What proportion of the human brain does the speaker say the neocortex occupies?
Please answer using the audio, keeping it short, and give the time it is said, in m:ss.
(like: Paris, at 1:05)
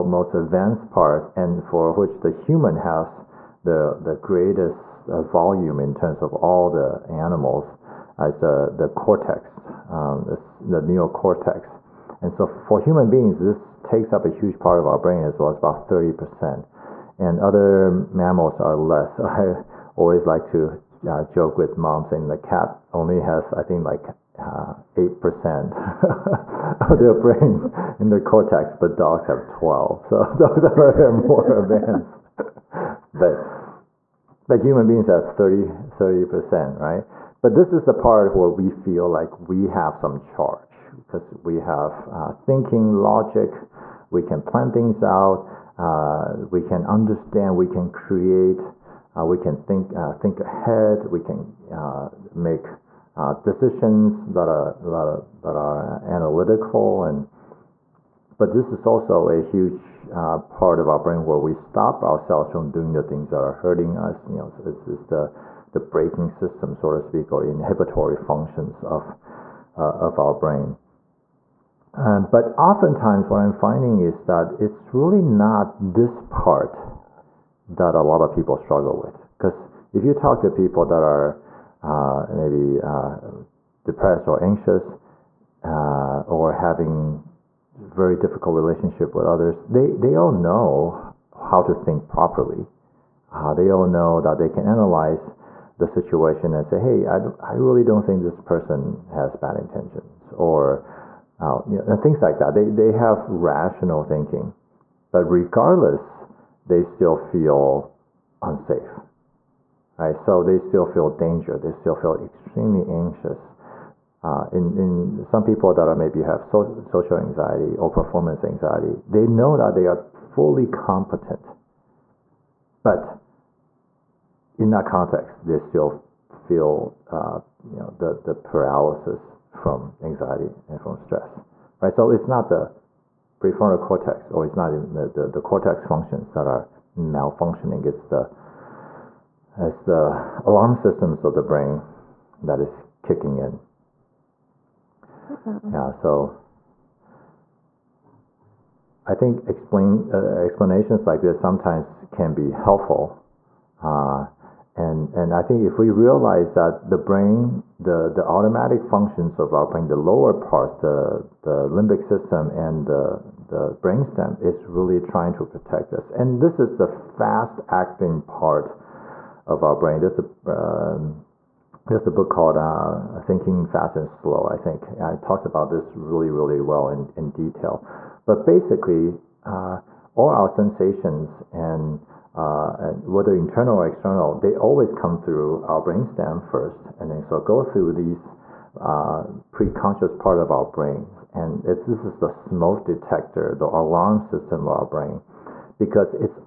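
30%, at 0:35.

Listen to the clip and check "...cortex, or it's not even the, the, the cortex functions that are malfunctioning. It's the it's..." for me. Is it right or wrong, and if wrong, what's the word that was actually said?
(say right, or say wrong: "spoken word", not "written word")
right.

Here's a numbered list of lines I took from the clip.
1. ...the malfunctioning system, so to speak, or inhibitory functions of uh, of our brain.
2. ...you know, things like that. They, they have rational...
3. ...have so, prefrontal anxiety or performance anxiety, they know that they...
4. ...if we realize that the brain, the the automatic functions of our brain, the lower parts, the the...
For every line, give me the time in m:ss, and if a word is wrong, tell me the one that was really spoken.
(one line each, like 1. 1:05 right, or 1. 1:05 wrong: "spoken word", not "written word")
1. 1:05 wrong: "braking", not "malfunctioning"
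2. 1:41 right
3. 1:56 wrong: "social", not "prefrontal"
4. 2:35 right.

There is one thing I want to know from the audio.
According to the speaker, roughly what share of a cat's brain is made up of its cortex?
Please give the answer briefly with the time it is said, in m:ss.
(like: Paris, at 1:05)
8%, at 0:24.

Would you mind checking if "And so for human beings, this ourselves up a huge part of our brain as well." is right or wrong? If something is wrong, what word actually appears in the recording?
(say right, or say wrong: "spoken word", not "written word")
wrong: "takes", not "ourselves".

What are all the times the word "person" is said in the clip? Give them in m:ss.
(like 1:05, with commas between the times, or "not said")
1:38.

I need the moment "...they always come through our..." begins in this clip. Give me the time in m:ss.
3:04.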